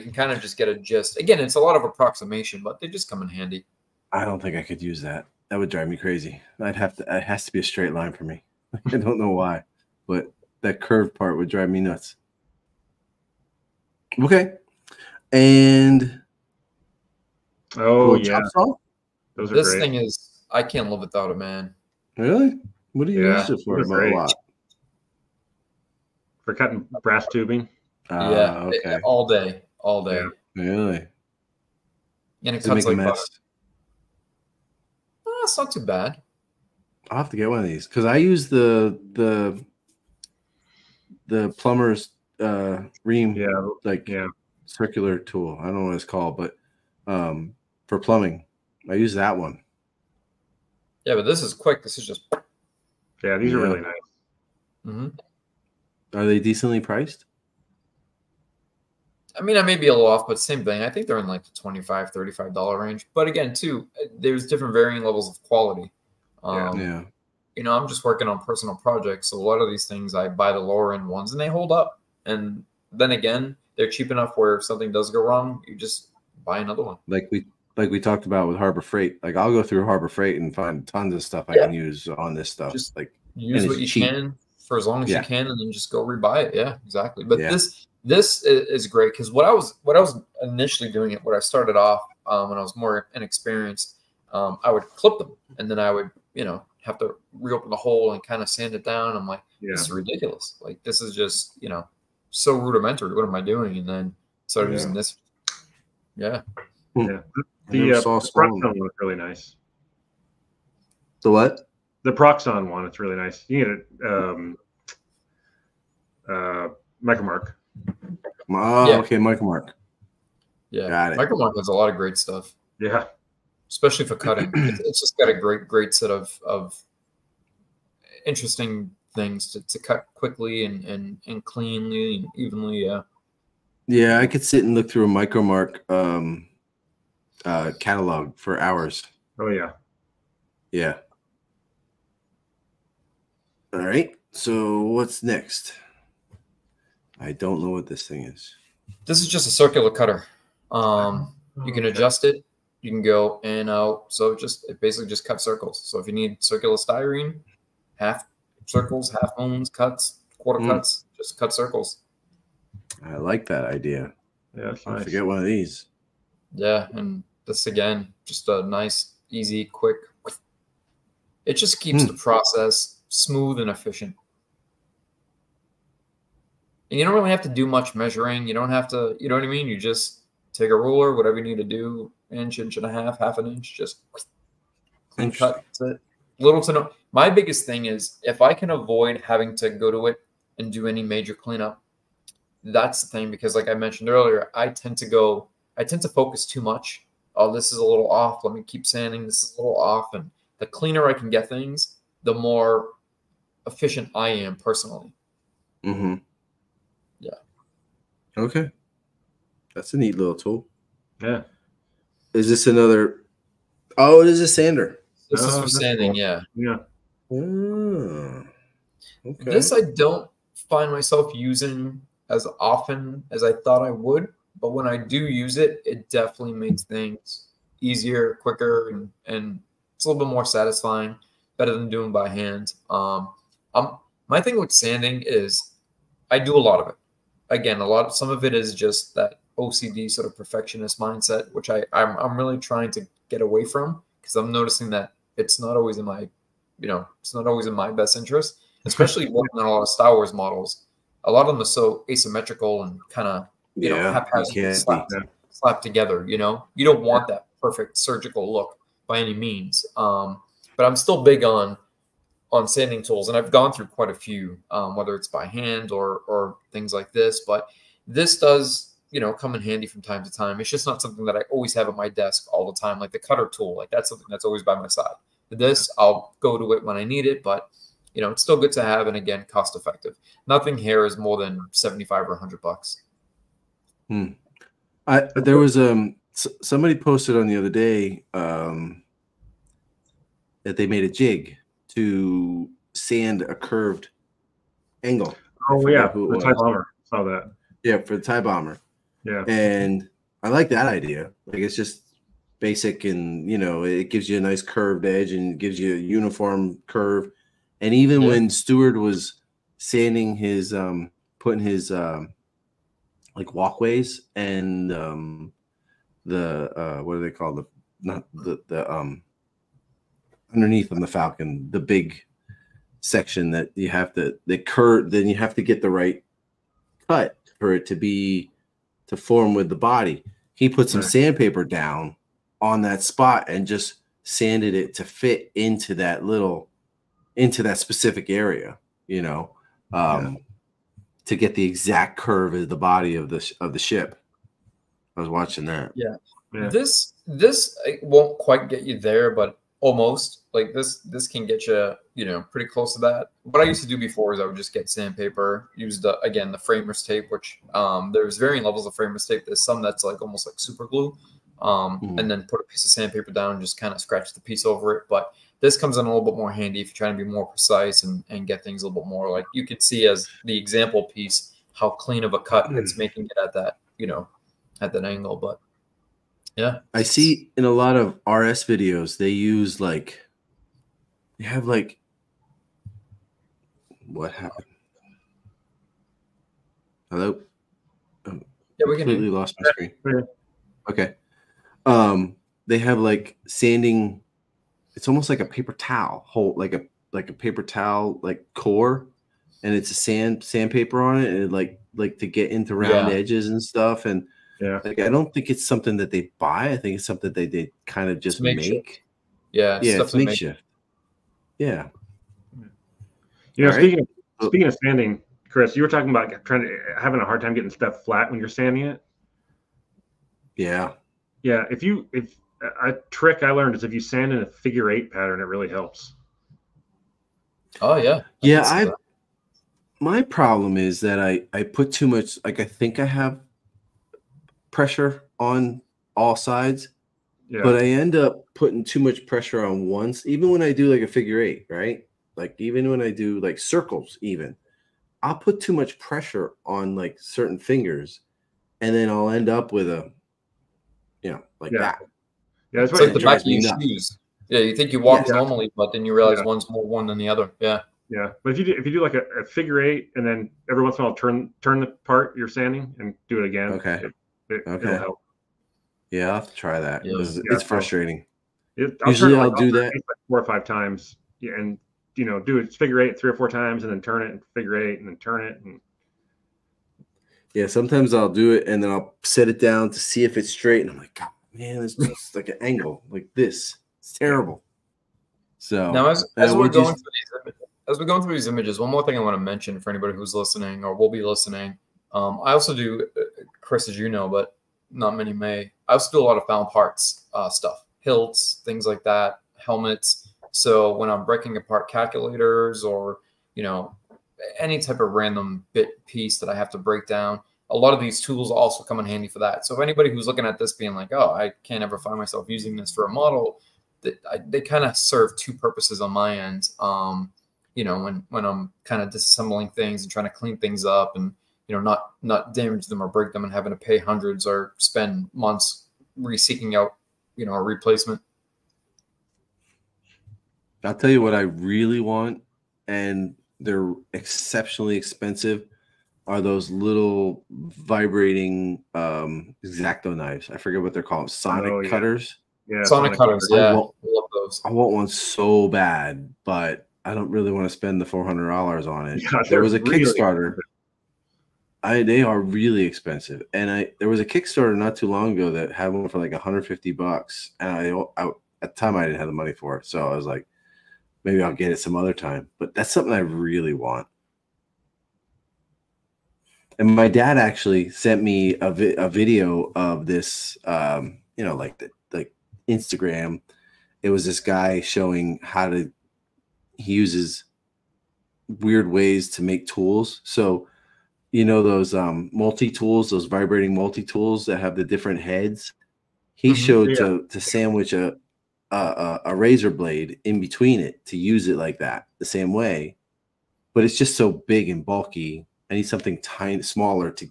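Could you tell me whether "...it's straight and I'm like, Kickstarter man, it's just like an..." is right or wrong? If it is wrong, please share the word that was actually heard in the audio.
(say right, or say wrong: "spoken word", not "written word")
wrong: "God", not "Kickstarter".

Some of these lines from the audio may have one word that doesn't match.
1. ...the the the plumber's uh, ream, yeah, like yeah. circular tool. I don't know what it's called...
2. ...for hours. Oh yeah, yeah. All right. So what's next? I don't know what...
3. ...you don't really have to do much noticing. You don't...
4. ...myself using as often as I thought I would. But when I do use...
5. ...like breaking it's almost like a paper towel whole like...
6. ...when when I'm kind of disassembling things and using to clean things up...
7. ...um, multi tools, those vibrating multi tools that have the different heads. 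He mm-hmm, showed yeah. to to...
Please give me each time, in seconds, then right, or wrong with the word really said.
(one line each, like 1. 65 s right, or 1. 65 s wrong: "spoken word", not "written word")
1. 38 s right
2. 138 s right
3. 176 s wrong: "measuring", not "noticing"
4. 220 s right
5. 392 s wrong: "sanding", not "breaking"
6. 517 s wrong: "trying", not "using"
7. 581 s right.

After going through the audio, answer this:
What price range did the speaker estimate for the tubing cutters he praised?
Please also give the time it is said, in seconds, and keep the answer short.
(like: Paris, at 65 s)
$25-$35, at 61 s.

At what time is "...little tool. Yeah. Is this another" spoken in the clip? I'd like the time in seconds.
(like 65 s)
210 s.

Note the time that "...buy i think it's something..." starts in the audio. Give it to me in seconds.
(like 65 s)
406 s.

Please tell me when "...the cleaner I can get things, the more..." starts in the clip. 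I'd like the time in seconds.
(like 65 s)
200 s.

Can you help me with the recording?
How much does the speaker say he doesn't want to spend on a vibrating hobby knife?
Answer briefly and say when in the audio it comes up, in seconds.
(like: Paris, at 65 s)
$400, at 548 s.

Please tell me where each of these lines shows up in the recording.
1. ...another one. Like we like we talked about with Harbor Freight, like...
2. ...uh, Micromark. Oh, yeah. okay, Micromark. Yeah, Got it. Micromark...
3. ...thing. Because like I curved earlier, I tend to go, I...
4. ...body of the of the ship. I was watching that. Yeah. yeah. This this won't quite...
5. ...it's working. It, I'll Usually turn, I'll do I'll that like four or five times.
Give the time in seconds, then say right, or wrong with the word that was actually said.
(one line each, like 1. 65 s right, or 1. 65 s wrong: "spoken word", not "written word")
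1. 76 s right
2. 116 s right
3. 193 s wrong: "mentioned", not "curved"
4. 342 s right
5. 467 s wrong: "frustrating", not "working".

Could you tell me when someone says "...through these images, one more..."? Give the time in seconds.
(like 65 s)
488 s.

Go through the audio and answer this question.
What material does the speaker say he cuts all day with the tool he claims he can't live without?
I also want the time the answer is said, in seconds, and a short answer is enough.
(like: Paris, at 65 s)
brass tubing, at 27 s.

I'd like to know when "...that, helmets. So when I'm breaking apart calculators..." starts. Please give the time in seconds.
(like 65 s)
499 s.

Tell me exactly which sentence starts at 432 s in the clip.
Like I think I have pressure on all sides, yeah.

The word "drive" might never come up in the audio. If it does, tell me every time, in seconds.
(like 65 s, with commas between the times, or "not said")
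5 s, 11 s.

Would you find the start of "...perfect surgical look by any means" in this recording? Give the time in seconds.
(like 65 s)
257 s.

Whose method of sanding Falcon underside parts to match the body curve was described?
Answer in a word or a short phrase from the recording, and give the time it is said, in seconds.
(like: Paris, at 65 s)
Stewart, at 308 s.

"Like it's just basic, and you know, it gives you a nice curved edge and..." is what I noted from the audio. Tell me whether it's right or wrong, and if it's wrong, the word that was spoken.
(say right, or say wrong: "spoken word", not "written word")
right.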